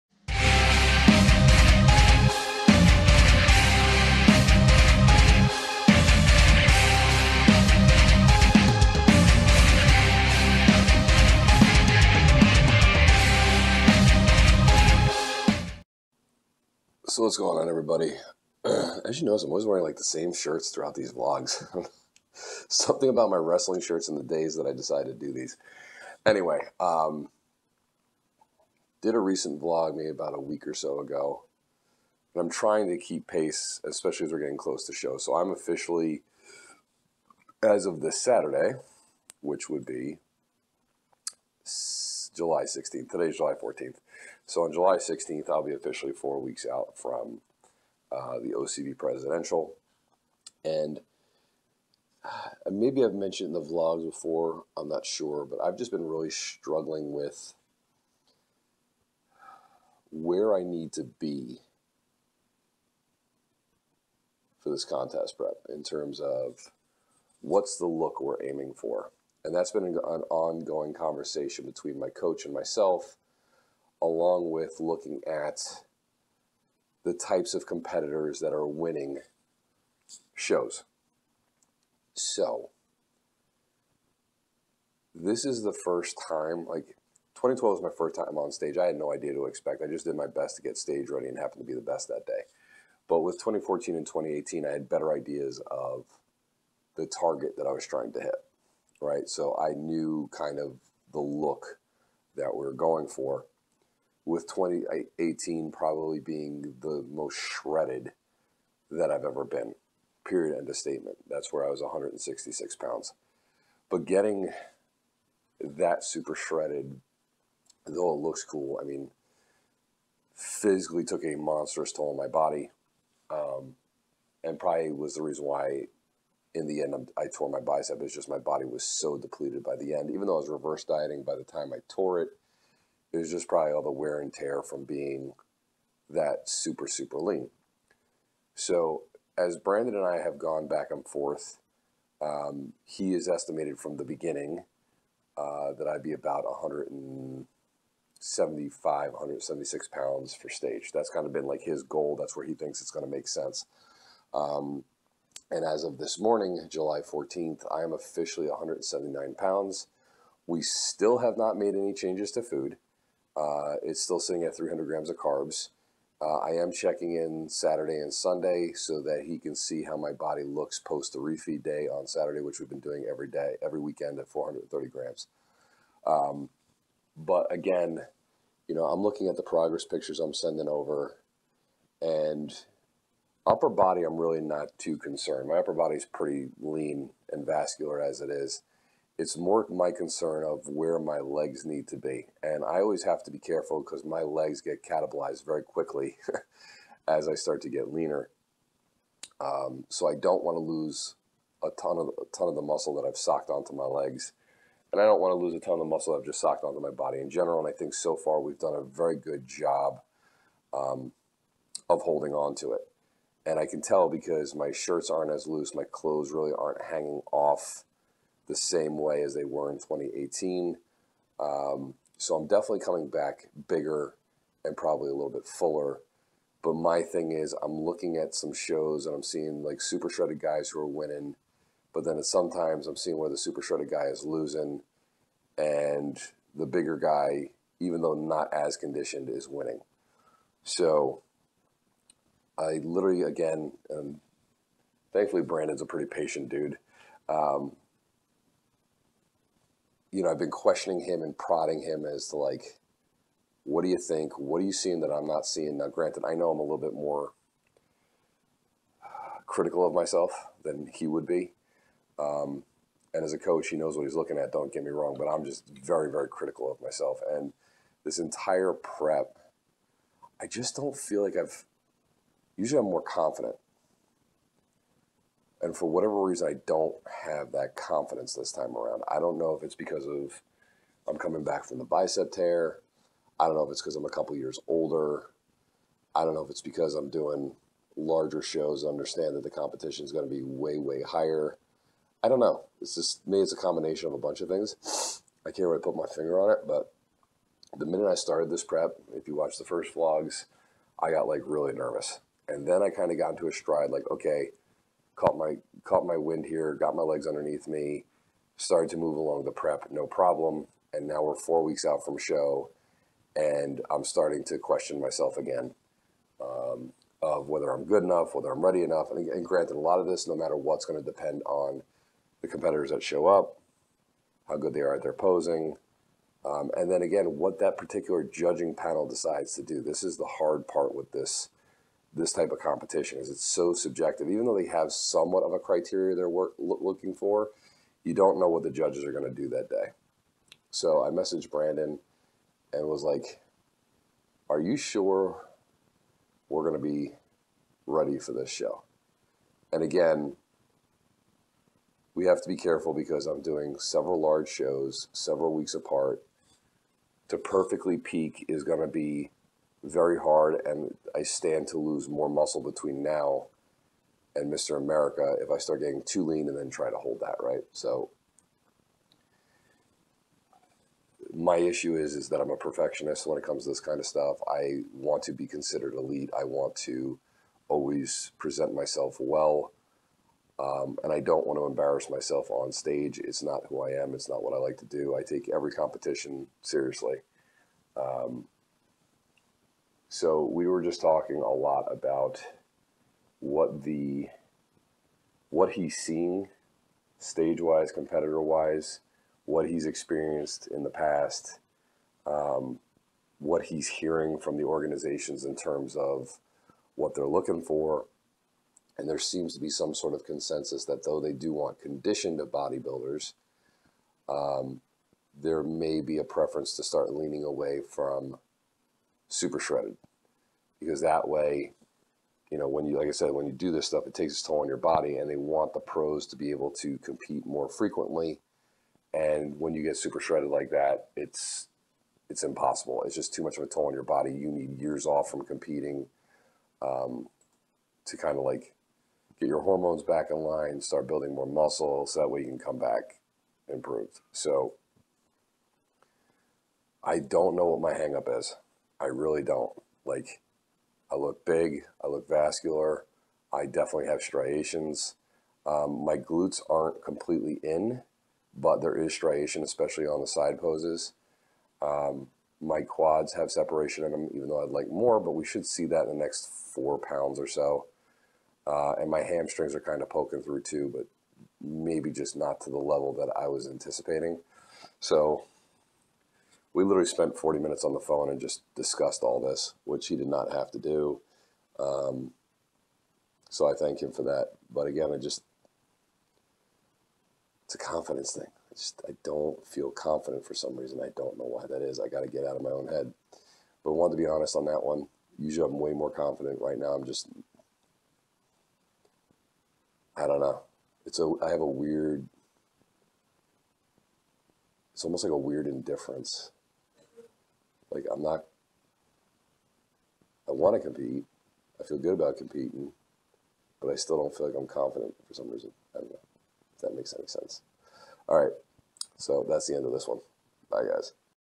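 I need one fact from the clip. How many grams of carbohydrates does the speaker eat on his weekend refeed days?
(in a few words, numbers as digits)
430 grams.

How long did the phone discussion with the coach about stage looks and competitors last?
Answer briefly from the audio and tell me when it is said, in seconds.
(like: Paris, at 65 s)
40 minutes, at 477 s.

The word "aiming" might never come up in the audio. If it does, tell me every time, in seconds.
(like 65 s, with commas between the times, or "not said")
68 s.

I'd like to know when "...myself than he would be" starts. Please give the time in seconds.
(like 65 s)
259 s.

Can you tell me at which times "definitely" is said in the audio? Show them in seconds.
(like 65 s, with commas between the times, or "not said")
222 s, 453 s.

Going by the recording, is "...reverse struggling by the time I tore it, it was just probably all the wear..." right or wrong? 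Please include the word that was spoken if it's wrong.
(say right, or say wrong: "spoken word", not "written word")
wrong: "dieting", not "struggling".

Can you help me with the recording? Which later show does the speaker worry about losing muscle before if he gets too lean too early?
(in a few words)
Mr. America.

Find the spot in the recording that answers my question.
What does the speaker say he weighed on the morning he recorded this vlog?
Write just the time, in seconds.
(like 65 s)
158 s.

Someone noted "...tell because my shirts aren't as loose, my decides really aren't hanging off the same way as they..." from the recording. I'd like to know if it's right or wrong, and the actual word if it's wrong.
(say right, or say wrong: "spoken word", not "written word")
wrong: "clothes", not "decides".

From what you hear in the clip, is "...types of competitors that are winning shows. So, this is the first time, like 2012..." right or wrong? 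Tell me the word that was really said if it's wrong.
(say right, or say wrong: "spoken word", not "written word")
right.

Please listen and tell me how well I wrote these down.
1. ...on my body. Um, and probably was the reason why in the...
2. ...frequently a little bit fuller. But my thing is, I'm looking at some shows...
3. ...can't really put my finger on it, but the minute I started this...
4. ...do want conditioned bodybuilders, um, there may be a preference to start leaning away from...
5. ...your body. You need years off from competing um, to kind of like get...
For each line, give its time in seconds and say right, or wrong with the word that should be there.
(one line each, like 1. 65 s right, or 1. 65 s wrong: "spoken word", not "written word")
1. 122 s right
2. 224 s wrong: "probably", not "frequently"
3. 295 s right
4. 411 s right
5. 433 s right.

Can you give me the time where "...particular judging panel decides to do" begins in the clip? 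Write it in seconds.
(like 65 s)
327 s.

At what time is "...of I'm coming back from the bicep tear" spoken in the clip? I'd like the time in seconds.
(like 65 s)
280 s.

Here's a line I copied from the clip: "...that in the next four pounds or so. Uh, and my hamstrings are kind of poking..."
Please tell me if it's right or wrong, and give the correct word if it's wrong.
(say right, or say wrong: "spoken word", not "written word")
right.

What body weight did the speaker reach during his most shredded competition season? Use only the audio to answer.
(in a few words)
166 pounds.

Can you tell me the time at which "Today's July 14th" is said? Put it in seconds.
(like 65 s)
43 s.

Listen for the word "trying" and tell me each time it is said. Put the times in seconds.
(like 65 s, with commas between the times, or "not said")
32 s, 97 s.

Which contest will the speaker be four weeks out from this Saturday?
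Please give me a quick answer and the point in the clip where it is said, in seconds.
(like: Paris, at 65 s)
OCB presidential, at 48 s.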